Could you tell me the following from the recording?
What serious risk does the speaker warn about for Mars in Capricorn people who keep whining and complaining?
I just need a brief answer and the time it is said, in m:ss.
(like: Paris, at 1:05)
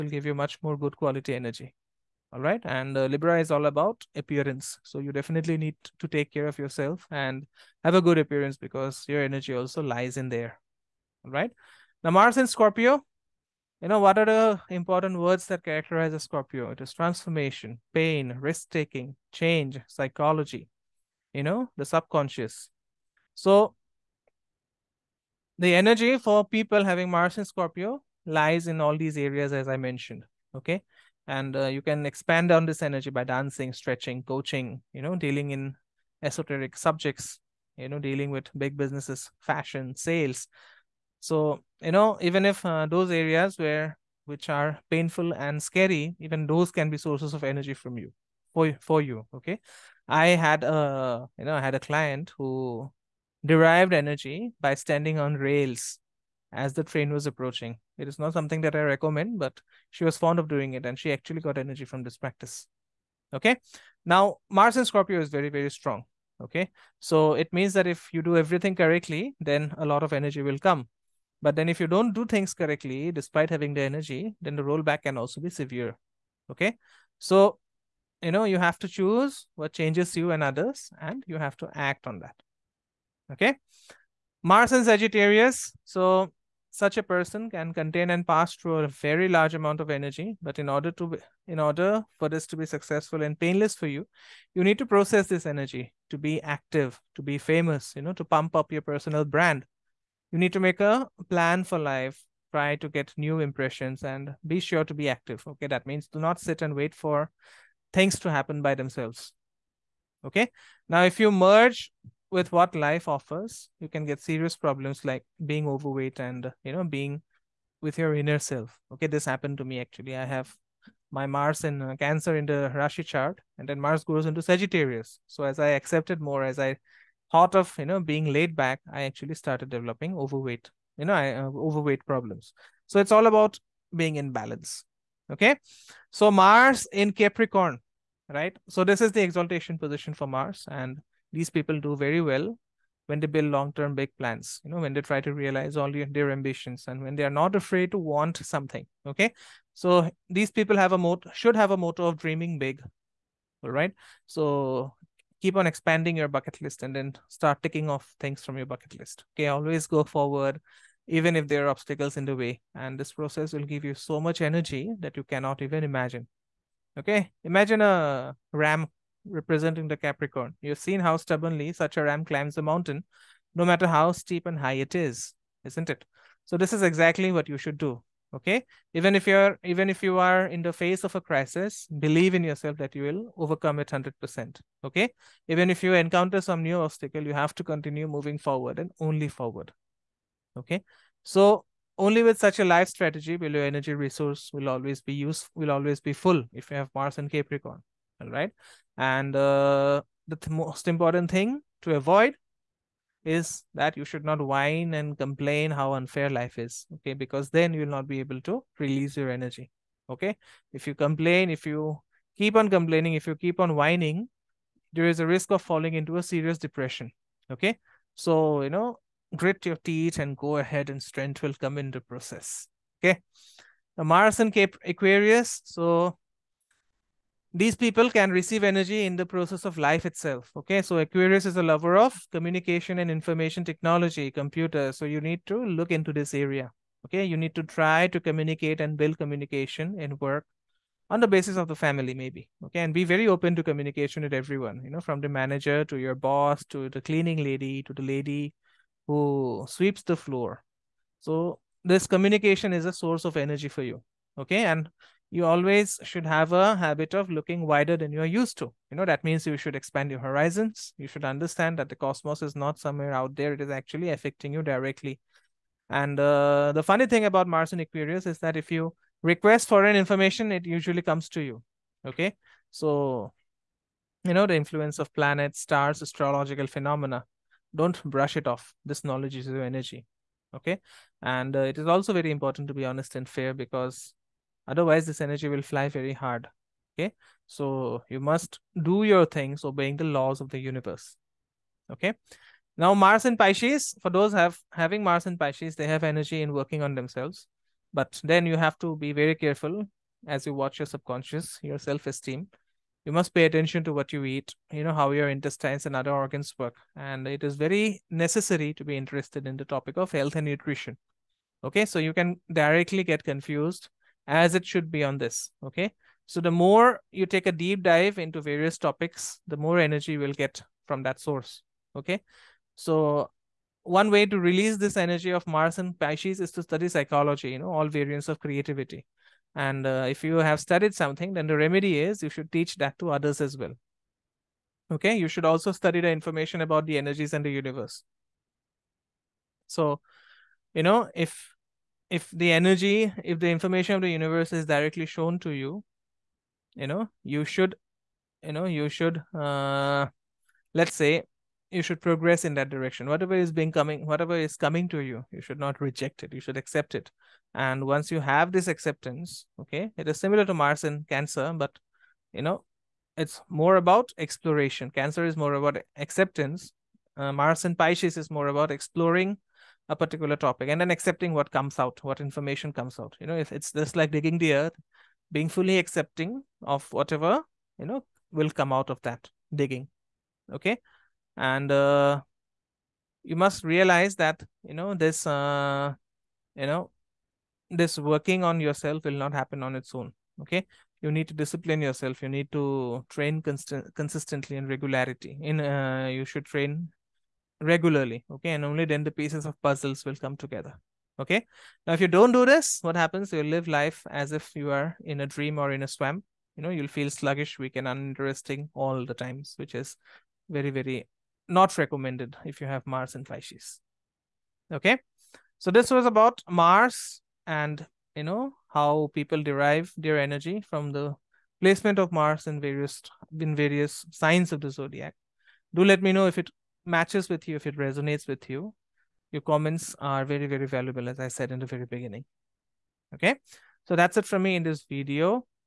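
Serious depression, at 3:36.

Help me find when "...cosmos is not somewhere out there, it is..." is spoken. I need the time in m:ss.
4:21.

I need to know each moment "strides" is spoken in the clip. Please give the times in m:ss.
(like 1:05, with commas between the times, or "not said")
not said.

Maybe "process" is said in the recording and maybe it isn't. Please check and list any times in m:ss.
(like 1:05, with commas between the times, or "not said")
1:34, 2:43, 3:42, 3:49.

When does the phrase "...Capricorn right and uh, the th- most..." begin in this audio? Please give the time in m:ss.
3:17.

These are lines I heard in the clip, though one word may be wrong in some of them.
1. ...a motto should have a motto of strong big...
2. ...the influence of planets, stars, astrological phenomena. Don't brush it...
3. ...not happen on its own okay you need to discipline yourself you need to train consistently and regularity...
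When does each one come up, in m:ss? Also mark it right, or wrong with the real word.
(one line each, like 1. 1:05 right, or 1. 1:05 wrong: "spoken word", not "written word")
1. 2:30 wrong: "dreaming", not "strong"
2. 4:34 right
3. 6:29 right.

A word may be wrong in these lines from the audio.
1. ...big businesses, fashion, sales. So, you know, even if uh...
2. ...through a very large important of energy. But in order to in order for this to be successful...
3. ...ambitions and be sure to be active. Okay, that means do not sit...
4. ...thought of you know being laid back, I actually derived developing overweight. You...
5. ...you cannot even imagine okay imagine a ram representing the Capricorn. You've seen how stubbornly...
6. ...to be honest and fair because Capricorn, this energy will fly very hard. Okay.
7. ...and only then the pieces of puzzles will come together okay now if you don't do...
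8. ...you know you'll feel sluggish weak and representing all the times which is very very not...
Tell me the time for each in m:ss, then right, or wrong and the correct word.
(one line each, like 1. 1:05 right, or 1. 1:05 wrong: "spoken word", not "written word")
1. 0:38 right
2. 1:28 wrong: "amount", not "important"
3. 1:43 wrong: "impressions", not "ambitions"
4. 2:07 wrong: "started", not "derived"
5. 2:45 right
6. 4:42 wrong: "Otherwise", not "Capricorn"
7. 6:38 right
8. 6:46 wrong: "uninteresting", not "representing".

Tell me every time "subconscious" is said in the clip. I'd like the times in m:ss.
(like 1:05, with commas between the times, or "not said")
0:21, 5:00.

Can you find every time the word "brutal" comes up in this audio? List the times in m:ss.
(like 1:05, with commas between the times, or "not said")
not said.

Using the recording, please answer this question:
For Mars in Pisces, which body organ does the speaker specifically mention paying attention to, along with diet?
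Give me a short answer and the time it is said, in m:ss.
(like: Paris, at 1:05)
Intestines, at 5:05.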